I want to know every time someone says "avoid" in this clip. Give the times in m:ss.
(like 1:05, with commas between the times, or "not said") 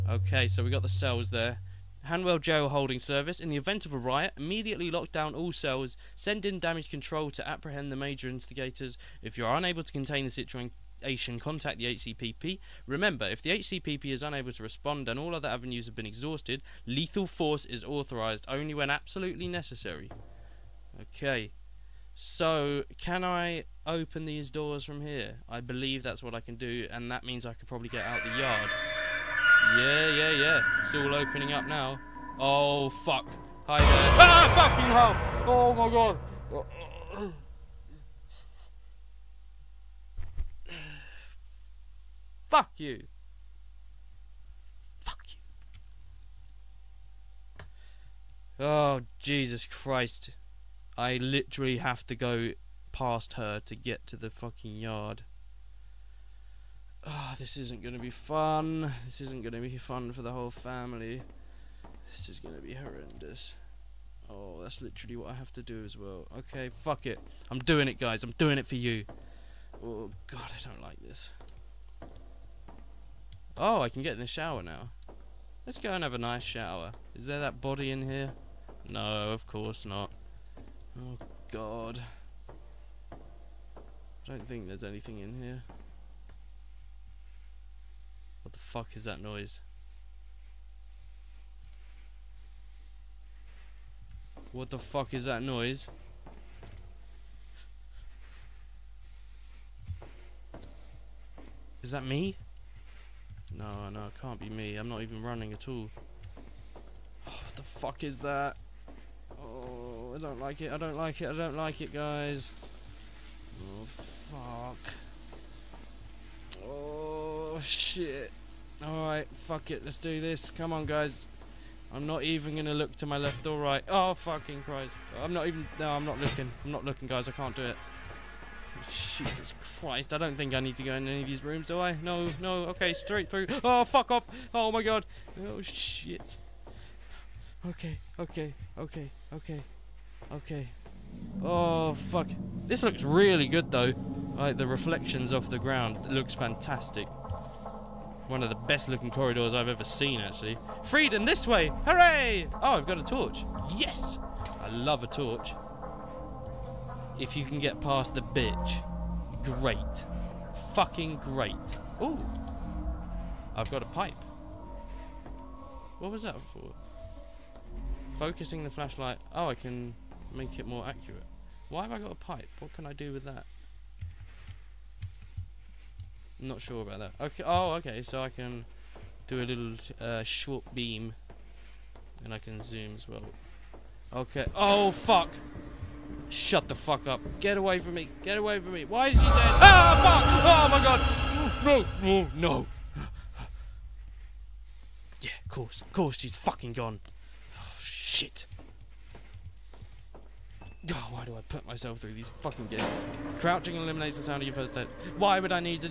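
not said.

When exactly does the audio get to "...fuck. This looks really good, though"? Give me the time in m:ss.
2:21.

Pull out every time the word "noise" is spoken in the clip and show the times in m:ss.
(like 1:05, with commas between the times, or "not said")
1:29, 1:35.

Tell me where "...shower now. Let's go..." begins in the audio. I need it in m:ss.
1:14.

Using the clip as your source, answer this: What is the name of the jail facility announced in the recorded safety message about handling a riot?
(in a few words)
Hanwell Jail Holding Service.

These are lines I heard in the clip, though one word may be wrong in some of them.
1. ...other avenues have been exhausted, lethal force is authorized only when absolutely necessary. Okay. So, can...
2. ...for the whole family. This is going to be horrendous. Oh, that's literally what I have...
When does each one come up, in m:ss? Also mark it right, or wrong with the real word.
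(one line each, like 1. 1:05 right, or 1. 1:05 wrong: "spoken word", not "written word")
1. 0:15 right
2. 1:00 right.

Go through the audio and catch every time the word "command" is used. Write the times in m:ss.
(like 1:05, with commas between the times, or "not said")
not said.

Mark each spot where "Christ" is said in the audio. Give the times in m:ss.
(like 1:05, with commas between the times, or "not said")
0:49, 2:04, 2:09.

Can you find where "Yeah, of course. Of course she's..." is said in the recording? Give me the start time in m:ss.
3:15.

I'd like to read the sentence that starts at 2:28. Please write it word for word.
One of the best looking corridors I've ever seen, actually.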